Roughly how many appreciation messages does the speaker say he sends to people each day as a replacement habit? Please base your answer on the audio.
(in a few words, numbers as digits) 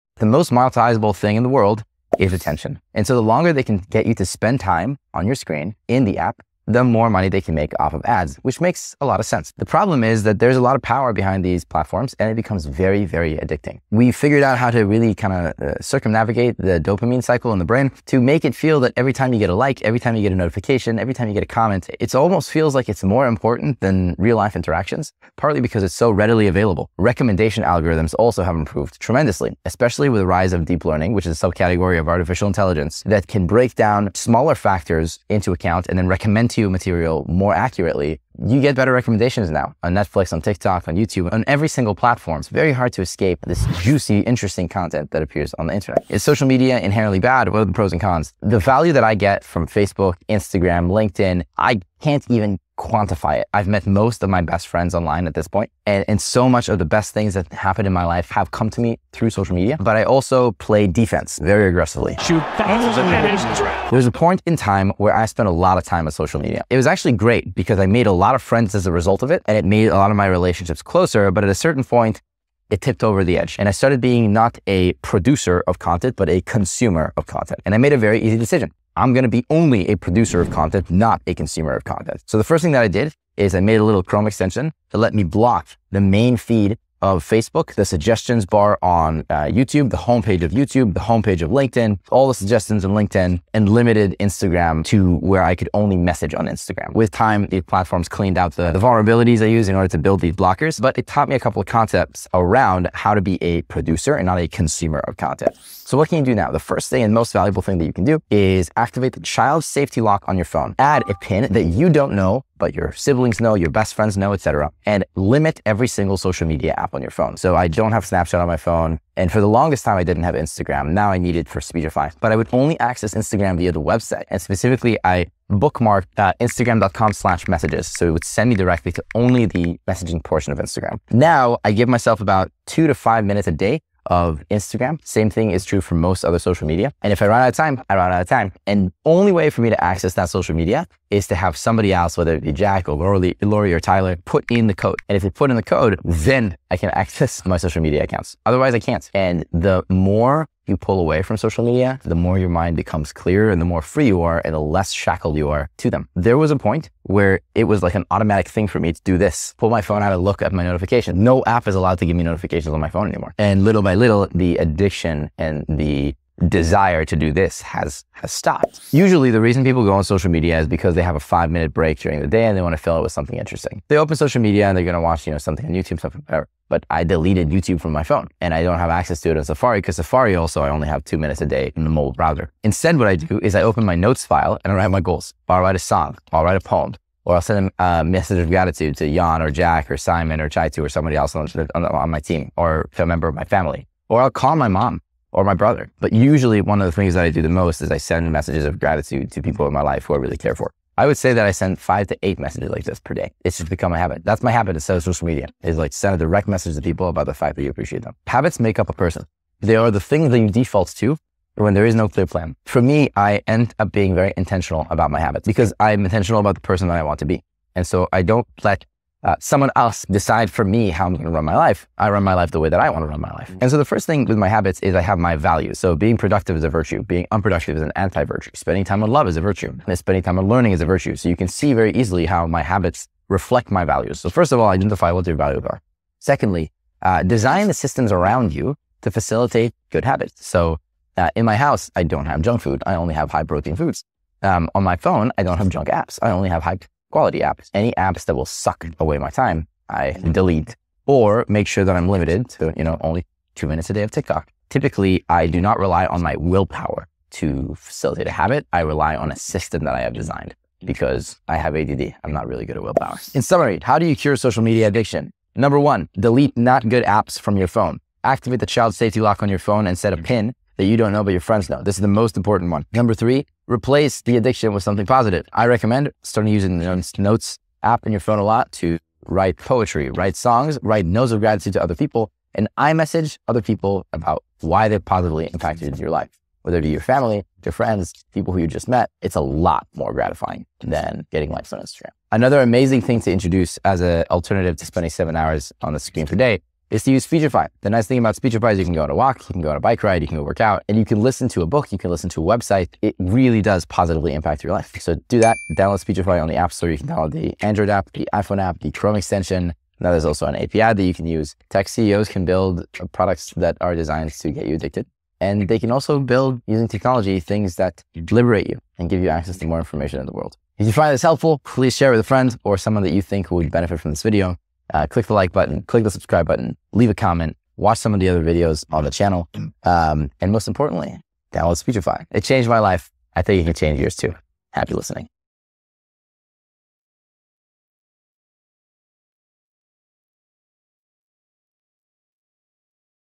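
5 to 8.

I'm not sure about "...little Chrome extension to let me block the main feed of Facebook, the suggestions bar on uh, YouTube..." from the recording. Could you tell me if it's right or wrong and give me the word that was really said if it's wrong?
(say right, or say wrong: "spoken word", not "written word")
right.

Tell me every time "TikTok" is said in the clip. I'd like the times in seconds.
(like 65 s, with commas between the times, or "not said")
40 s, 254 s.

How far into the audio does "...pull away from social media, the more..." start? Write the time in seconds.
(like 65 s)
150 s.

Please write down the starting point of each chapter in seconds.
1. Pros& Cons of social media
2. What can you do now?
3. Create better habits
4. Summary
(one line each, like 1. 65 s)
1. 45 s
2. 105 s
3. 168 s
4. 262 s.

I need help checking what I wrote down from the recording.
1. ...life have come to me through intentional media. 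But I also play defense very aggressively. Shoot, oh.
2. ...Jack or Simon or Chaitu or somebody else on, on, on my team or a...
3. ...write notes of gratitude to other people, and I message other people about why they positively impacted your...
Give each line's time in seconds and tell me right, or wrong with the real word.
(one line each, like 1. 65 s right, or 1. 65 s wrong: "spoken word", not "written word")
1. 58 s wrong: "social", not "intentional"
2. 189 s right
3. 280 s right.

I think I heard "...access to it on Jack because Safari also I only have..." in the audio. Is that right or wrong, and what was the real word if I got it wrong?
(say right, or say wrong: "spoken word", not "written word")
wrong: "Safari", not "Jack".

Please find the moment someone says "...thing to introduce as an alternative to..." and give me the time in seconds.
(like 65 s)
293 s.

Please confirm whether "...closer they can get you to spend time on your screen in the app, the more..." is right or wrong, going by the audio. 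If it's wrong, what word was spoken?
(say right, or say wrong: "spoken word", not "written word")
wrong: "longer", not "closer".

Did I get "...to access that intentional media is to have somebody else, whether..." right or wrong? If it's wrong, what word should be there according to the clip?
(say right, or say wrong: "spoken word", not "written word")
wrong: "social", not "intentional".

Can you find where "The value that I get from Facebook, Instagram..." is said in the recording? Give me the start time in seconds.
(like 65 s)
48 s.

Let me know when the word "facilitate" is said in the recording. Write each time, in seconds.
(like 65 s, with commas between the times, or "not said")
239 s, 257 s.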